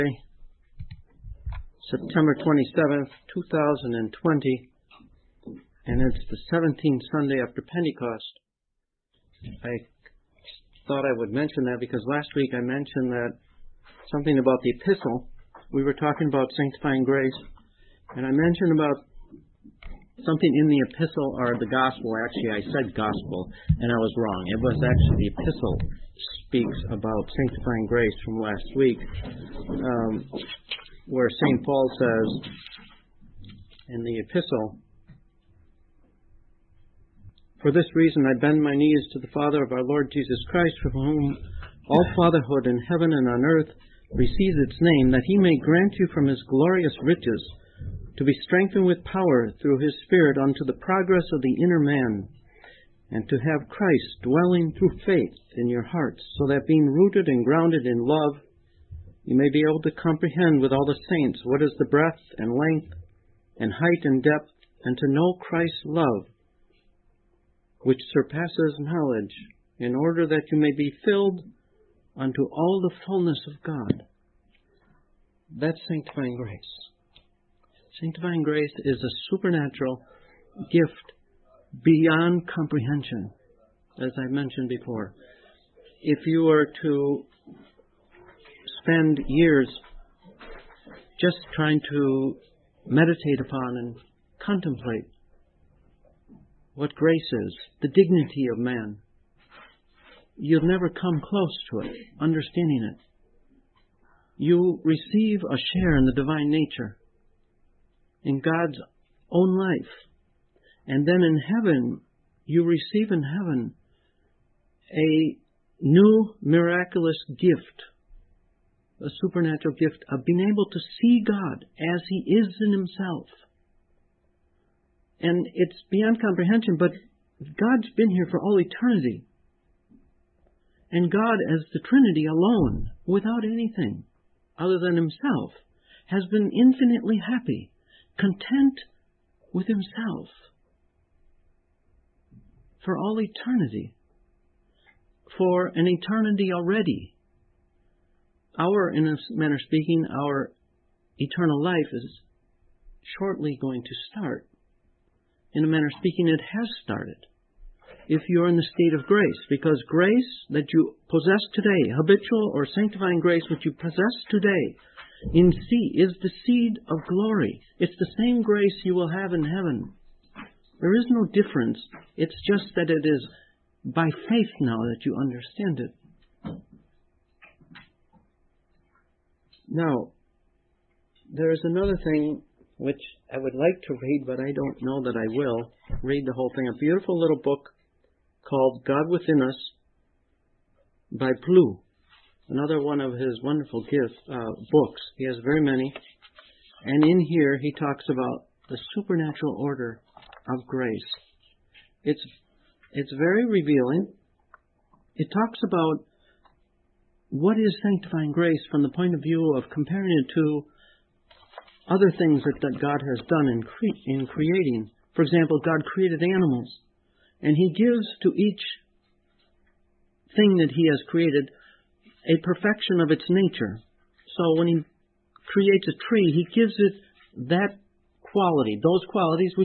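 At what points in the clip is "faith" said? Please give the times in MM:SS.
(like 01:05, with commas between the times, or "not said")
00:55, 02:54.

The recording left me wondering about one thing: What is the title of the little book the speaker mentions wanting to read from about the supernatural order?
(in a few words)
God Within Us.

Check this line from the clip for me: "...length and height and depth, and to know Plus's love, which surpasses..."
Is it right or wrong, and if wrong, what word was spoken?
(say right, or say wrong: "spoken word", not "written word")
wrong: "Christ", not "Plus".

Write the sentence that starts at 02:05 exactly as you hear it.
And it's beyond comprehension, but God's been here for all eternity.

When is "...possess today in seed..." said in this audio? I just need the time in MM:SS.
02:43.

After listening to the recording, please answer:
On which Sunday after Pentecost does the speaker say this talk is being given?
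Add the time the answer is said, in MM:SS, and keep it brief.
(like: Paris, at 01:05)
17th, at 00:06.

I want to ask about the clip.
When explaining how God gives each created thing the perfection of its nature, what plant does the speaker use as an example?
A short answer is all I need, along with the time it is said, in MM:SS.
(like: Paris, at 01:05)
A tree, at 03:45.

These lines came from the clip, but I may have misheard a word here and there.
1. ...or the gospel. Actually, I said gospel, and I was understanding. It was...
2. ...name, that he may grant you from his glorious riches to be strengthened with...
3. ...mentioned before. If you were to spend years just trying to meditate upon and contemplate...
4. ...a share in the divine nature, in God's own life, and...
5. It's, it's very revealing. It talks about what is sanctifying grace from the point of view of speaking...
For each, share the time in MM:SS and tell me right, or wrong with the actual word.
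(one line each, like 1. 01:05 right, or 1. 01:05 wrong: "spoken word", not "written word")
1. 00:21 wrong: "wrong", not "understanding"
2. 00:44 right
3. 01:24 right
4. 01:45 right
5. 03:22 wrong: "comparing", not "speaking".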